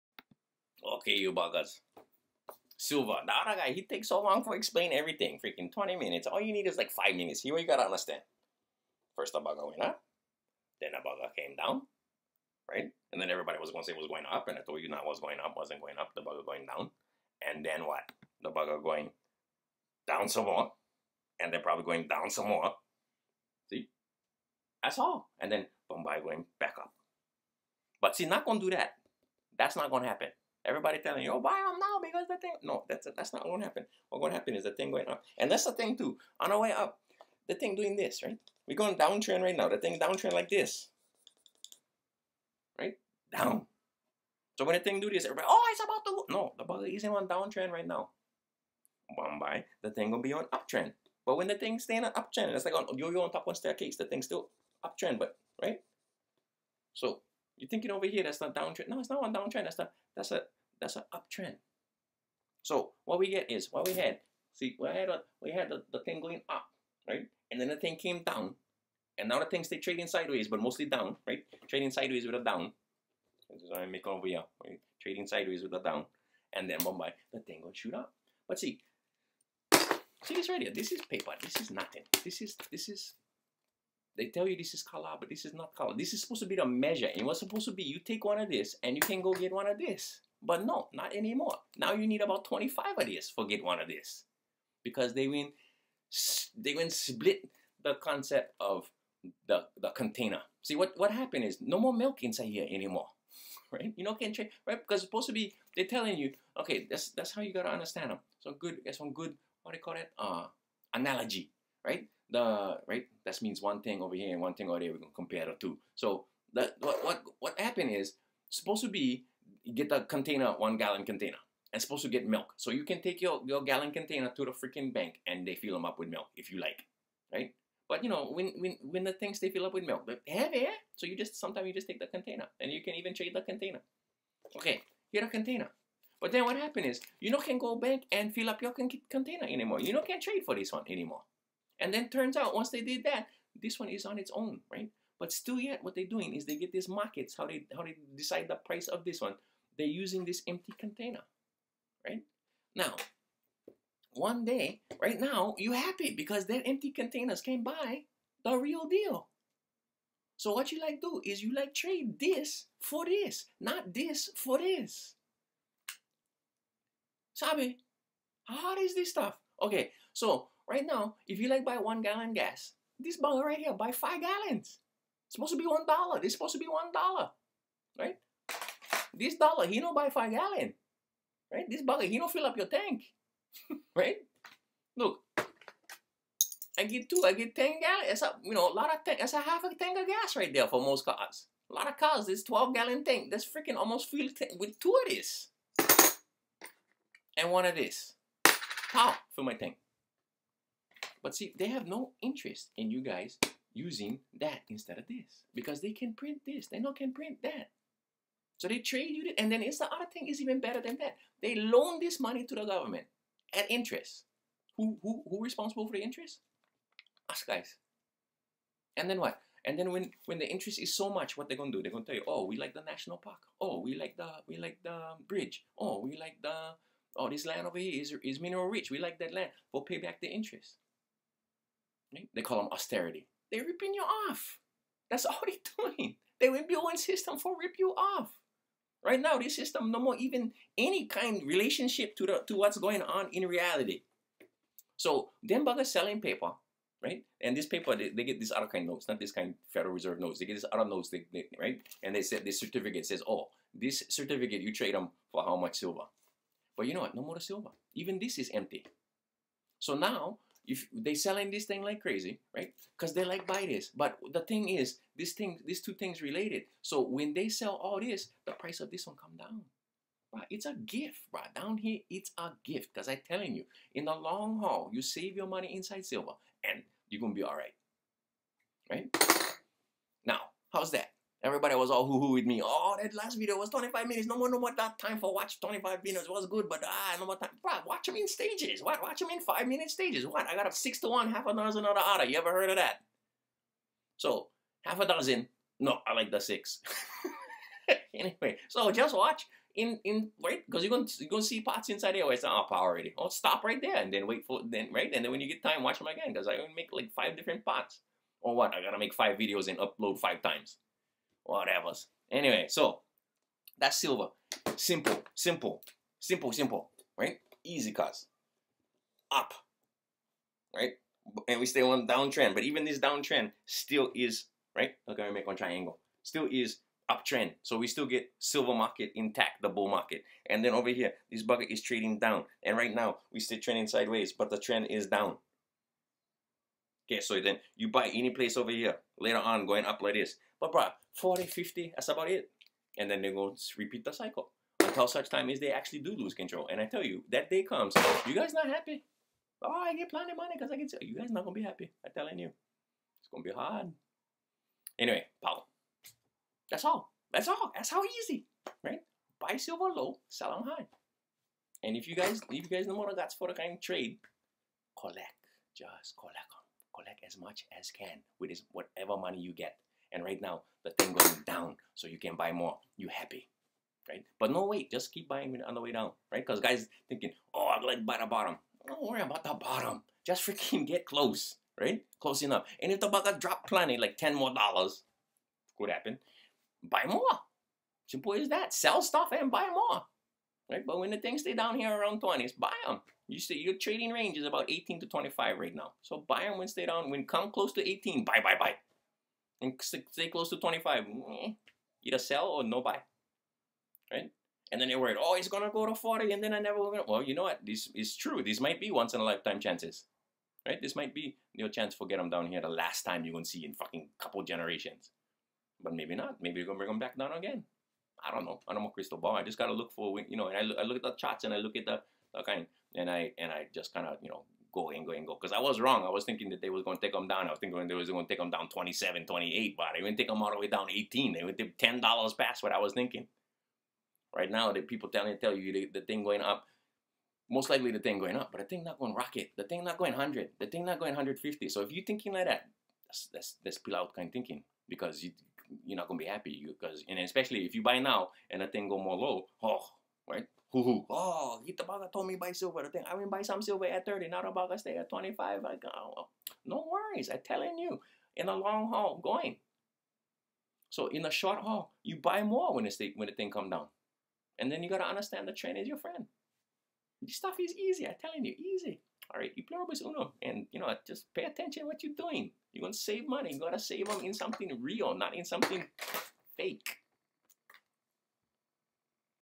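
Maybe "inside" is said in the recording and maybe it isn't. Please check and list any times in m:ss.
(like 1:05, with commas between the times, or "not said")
1:42, 4:35, 5:01.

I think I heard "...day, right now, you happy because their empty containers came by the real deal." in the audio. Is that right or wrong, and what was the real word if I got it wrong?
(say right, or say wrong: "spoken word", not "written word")
right.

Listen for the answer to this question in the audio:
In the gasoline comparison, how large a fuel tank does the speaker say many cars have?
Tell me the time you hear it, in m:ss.
3:12.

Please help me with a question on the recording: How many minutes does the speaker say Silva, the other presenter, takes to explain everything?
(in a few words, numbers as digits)
20 minutes.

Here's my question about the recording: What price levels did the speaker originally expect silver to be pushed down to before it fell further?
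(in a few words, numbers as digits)
27, 28.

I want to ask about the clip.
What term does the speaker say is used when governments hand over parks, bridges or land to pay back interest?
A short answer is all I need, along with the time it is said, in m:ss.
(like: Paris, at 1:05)
austerity, at 3:52.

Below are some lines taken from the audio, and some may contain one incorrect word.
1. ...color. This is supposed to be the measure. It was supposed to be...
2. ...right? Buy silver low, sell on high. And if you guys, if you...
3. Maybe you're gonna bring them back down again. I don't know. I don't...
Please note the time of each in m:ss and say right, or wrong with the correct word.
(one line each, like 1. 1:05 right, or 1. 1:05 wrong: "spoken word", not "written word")
1. 1:25 right
2. 5:58 right
3. 6:56 right.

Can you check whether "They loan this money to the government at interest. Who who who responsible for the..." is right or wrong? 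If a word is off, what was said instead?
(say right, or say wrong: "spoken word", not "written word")
right.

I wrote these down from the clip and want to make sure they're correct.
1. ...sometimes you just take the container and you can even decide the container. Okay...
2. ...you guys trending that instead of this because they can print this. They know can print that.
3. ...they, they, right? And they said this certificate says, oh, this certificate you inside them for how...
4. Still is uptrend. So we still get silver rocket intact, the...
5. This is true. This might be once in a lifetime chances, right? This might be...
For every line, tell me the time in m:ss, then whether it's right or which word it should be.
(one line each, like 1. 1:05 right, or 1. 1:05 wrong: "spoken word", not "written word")
1. 2:11 wrong: "trade", not "decide"
2. 3:22 wrong: "using", not "trending"
3. 4:11 wrong: "trade", not "inside"
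4. 5:26 wrong: "market", not "rocket"
5. 6:47 right.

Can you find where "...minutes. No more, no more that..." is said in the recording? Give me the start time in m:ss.
4:44.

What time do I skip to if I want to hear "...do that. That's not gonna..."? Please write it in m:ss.
0:28.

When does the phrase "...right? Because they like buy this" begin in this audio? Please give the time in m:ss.
4:22.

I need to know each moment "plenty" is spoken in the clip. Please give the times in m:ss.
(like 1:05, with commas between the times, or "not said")
5:50, 6:23.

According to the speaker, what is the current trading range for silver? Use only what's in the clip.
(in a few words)
18 to 25.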